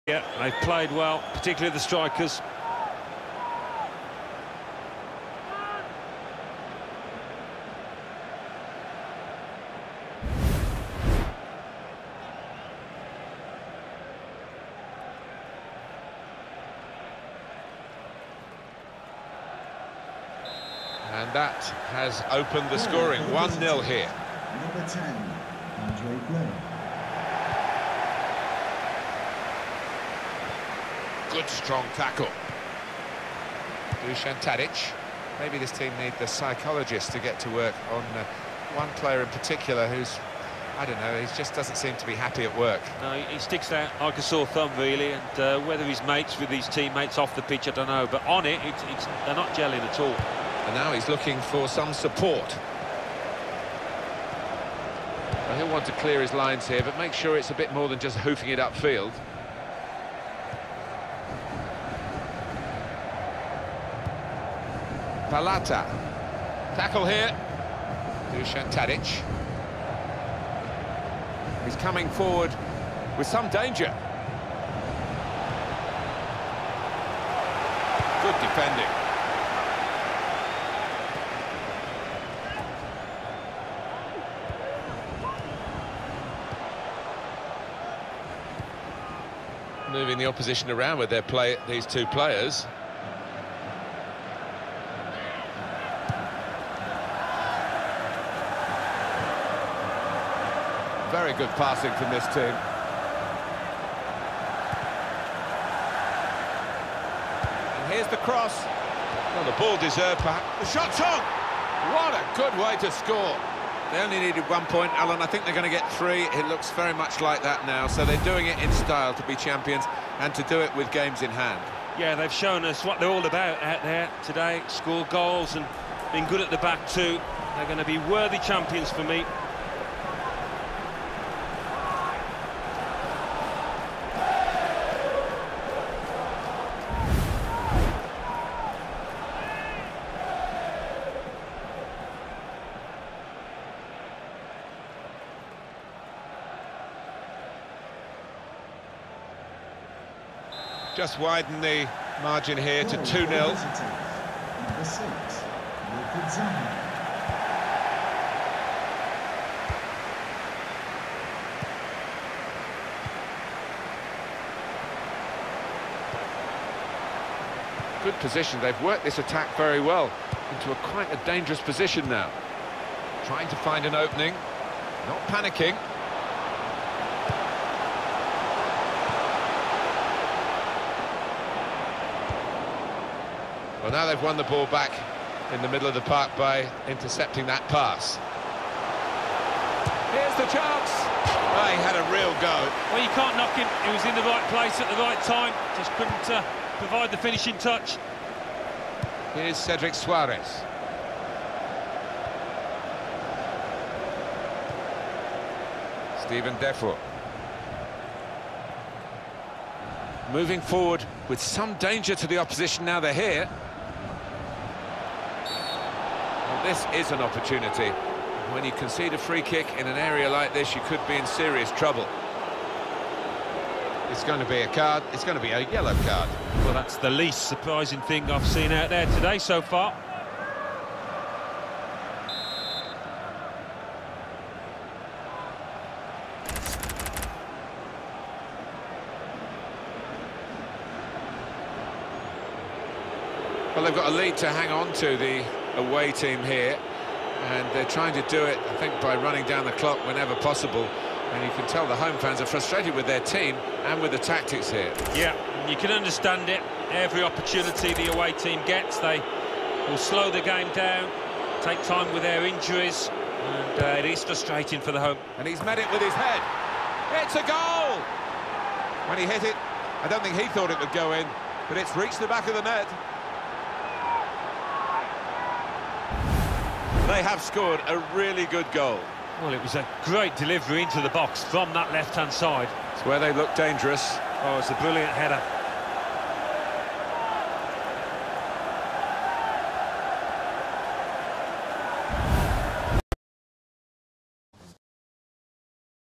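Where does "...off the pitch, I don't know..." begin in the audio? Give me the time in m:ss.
0:47.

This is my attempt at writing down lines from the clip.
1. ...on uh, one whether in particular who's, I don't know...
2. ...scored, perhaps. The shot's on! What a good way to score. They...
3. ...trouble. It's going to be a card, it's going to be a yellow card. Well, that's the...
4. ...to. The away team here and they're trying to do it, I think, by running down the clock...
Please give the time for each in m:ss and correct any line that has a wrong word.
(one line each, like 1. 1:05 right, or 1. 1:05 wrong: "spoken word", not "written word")
1. 0:37 wrong: "player", not "whether"
2. 1:49 wrong: "deserved", not "scored"
3. 3:41 right
4. 4:04 right.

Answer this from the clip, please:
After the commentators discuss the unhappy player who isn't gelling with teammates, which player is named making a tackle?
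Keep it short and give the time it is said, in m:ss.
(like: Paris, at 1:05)
Palata, at 1:05.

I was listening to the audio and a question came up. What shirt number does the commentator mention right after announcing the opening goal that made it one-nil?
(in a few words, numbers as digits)
10.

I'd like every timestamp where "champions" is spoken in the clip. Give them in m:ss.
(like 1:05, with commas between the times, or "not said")
1:59, 2:08.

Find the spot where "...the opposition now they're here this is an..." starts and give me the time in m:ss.
3:32.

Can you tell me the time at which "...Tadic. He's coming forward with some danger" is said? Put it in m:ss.
1:08.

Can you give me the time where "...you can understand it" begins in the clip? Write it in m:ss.
4:15.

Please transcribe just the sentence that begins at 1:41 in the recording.
Very good passing from this team.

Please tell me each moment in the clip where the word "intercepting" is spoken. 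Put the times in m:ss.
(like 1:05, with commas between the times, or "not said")
3:06.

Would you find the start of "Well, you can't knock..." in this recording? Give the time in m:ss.
3:12.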